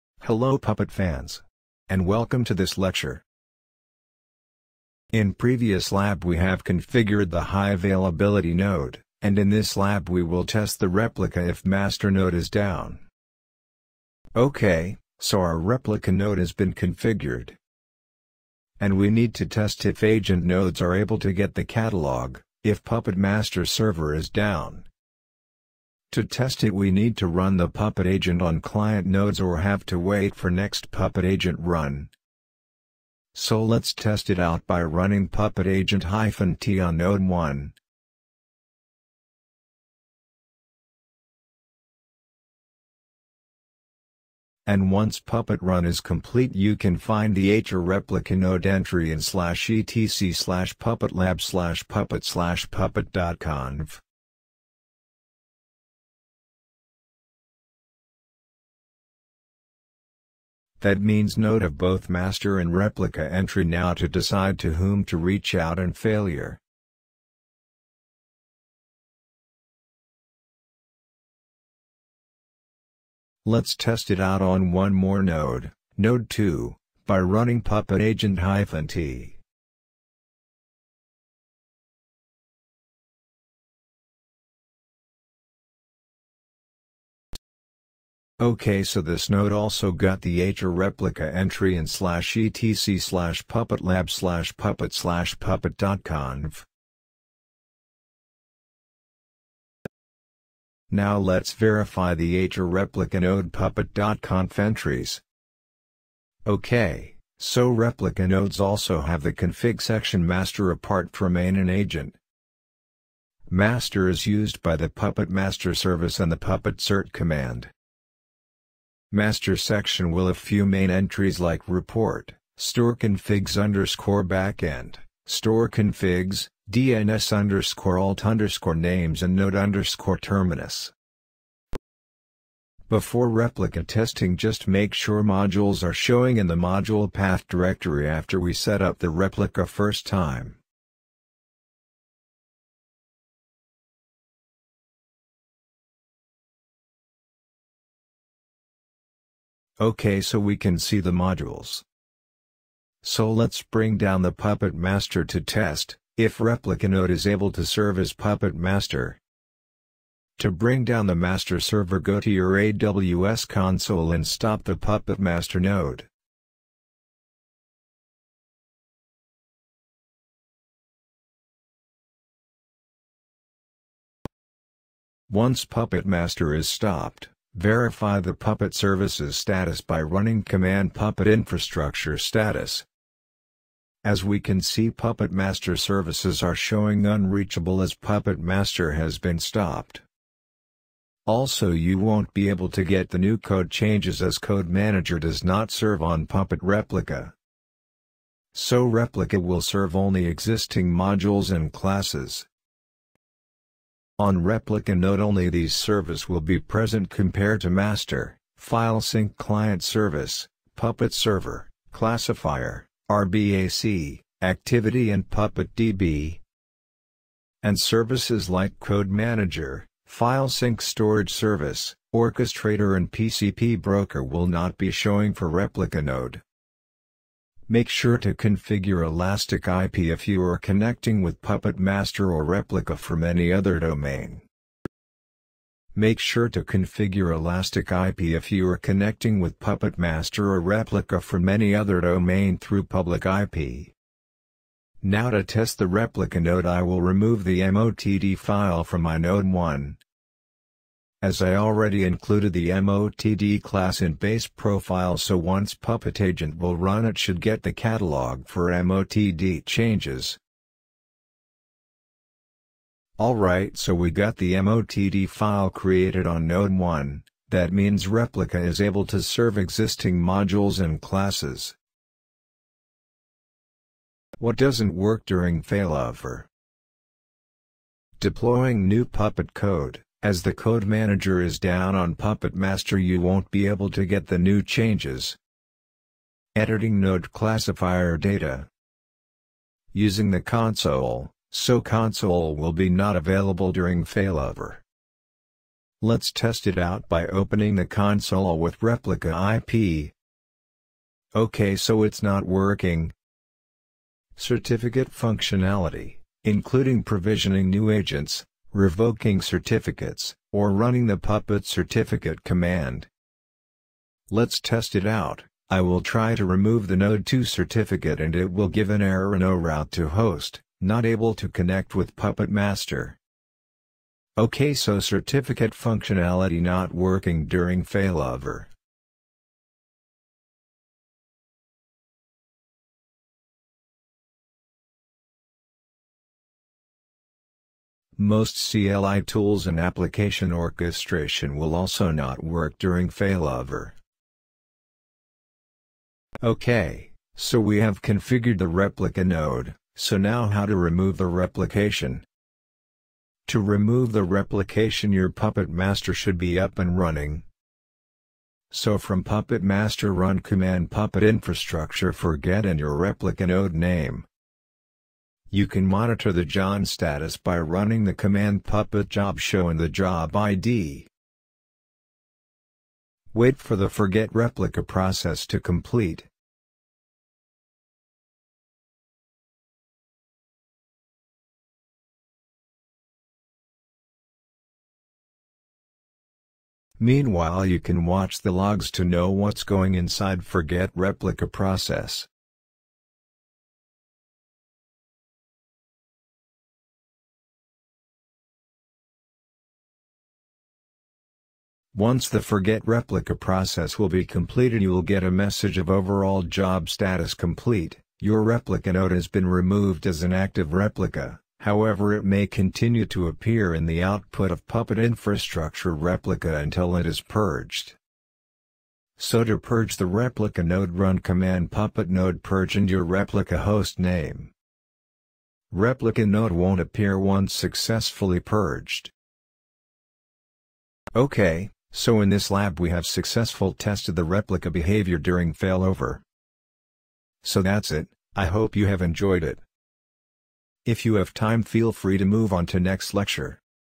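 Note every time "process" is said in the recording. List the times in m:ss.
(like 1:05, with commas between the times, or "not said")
6:14, 6:31, 6:43.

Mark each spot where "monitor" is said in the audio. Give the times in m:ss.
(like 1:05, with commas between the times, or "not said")
6:05.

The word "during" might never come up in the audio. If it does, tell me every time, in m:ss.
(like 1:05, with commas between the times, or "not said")
4:35, 4:53, 5:27, 5:42, 7:15.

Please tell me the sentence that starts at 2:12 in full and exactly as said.
Before replica testing just make sure modules are showing in the module path directory after we set up the replica first time.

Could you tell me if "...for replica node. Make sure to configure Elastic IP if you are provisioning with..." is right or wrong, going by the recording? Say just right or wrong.
wrong.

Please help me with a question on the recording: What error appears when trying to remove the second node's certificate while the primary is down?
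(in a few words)
no route to host.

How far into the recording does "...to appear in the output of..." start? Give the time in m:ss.
6:53.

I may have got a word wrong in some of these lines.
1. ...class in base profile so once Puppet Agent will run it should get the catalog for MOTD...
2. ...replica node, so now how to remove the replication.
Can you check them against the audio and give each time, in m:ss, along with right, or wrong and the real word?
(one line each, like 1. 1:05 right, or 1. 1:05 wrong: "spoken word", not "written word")
1. 4:13 right
2. 5:48 right.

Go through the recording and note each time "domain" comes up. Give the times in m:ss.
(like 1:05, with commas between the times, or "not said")
3:53, 4:02.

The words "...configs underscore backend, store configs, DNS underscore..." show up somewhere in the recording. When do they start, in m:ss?
2:02.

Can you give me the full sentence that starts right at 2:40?
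To bring down the master server go to your AWS console and stop the Puppet Master node.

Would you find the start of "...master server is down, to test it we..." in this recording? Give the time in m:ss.
0:23.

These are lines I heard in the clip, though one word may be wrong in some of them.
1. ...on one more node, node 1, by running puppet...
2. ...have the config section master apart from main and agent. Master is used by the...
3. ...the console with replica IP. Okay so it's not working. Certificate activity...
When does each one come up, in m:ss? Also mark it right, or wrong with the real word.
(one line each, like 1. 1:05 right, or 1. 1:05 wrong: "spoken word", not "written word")
1. 1:14 wrong: "2", not "1"
2. 1:49 right
3. 4:57 wrong: "functionality", not "activity".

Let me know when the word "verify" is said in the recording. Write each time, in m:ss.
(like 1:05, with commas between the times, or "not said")
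1:41, 2:57.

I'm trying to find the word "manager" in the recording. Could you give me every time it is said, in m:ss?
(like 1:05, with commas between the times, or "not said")
3:14, 3:39, 4:40.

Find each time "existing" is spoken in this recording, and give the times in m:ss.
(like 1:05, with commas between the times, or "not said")
3:20, 4:29.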